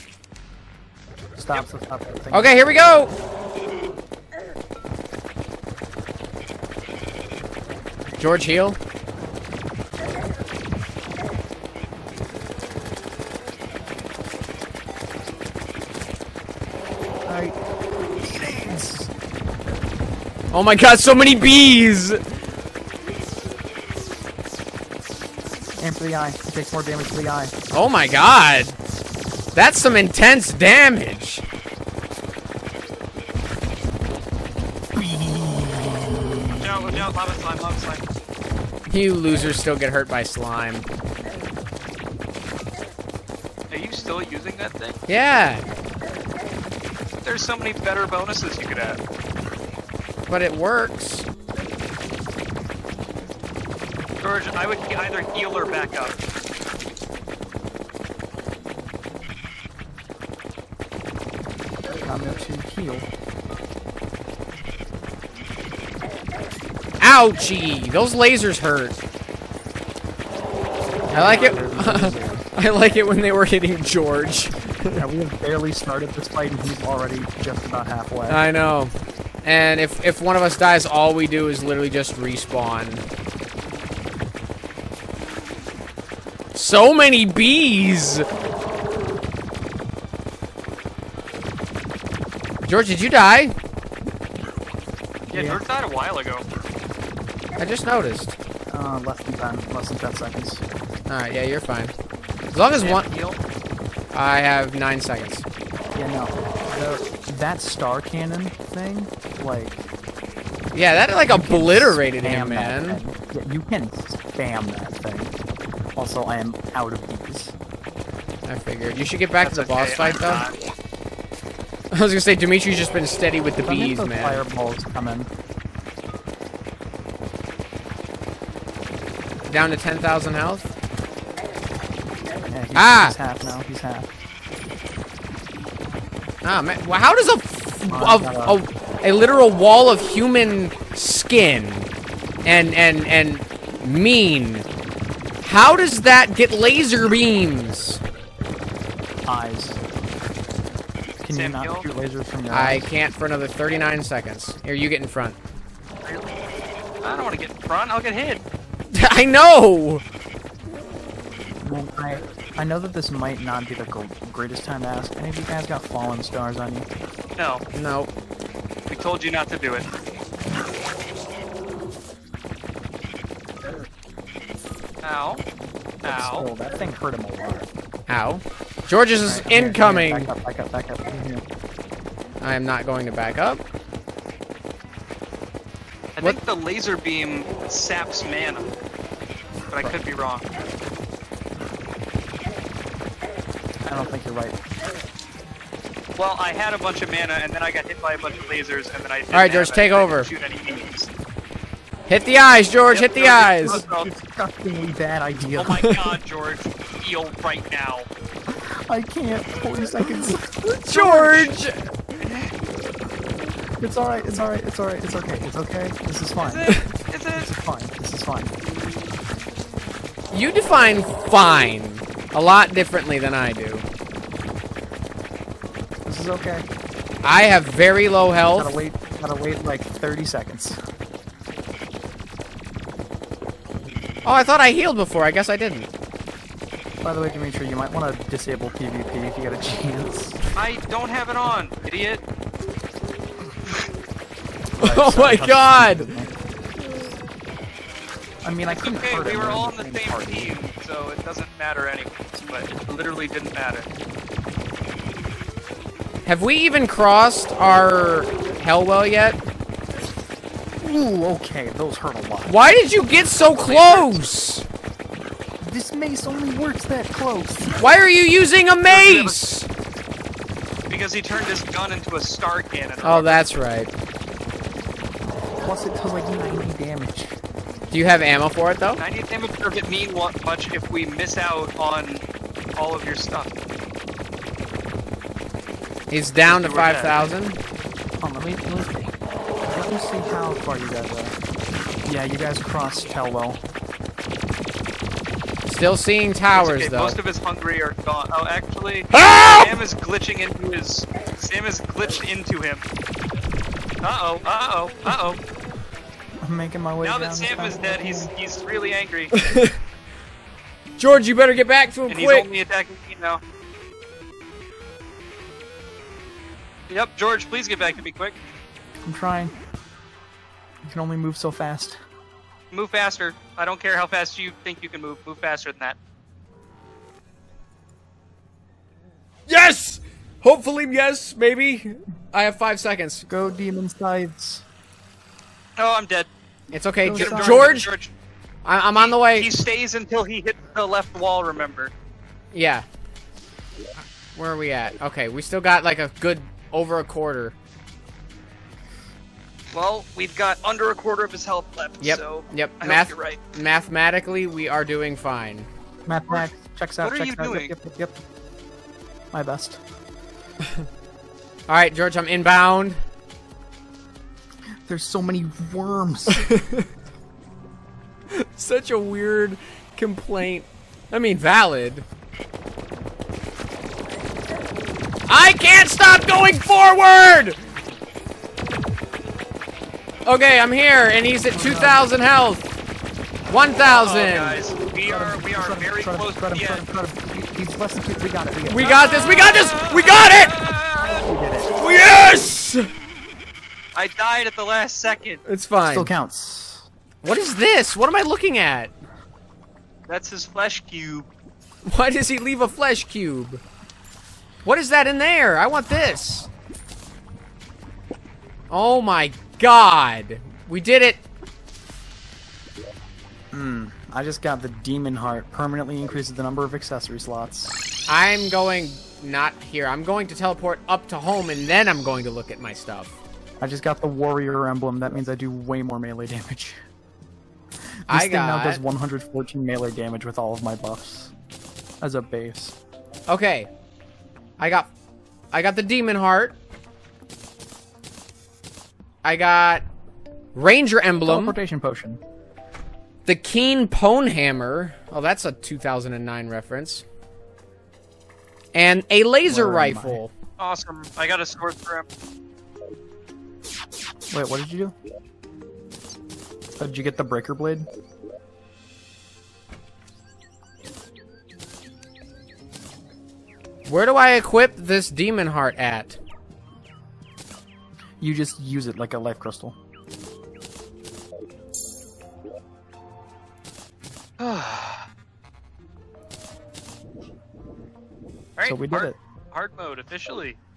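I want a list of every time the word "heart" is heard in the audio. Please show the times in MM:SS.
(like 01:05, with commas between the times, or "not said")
06:55, 07:16, 07:45.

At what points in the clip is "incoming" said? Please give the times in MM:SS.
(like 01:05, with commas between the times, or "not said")
02:59.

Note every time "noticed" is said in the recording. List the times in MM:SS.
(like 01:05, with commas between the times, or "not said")
01:37.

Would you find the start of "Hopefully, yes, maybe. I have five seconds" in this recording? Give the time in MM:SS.
05:30.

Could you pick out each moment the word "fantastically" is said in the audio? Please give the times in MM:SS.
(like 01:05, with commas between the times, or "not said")
not said.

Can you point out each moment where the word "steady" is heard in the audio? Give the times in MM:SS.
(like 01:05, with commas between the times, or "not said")
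02:03.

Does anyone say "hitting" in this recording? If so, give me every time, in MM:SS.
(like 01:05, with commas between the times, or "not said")
01:13.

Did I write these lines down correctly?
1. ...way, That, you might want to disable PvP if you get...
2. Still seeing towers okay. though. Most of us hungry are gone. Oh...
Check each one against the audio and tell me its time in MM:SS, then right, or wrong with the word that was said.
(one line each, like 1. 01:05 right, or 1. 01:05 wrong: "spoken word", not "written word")
1. 03:57 wrong: "Dimitri", not "That"
2. 04:55 right.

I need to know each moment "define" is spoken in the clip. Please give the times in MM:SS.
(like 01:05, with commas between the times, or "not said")
03:40.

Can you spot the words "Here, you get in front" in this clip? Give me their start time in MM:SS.
02:34.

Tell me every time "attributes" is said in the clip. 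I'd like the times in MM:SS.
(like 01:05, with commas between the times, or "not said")
not said.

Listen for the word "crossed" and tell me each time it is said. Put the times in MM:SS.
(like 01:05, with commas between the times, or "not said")
04:16, 04:52.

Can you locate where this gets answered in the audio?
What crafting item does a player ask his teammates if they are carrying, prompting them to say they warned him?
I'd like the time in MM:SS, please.
02:45.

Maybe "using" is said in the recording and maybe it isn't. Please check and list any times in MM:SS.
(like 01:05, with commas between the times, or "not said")
00:44, 04:28.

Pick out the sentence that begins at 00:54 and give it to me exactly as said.
George, I would either heal or back up.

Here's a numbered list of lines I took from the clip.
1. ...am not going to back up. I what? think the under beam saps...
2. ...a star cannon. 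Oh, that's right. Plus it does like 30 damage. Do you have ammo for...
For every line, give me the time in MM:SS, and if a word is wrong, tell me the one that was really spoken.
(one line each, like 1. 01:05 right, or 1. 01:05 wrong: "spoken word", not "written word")
1. 03:02 wrong: "laser", not "under"
2. 04:32 wrong: "90", not "30".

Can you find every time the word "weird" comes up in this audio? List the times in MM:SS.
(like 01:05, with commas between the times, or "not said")
06:08.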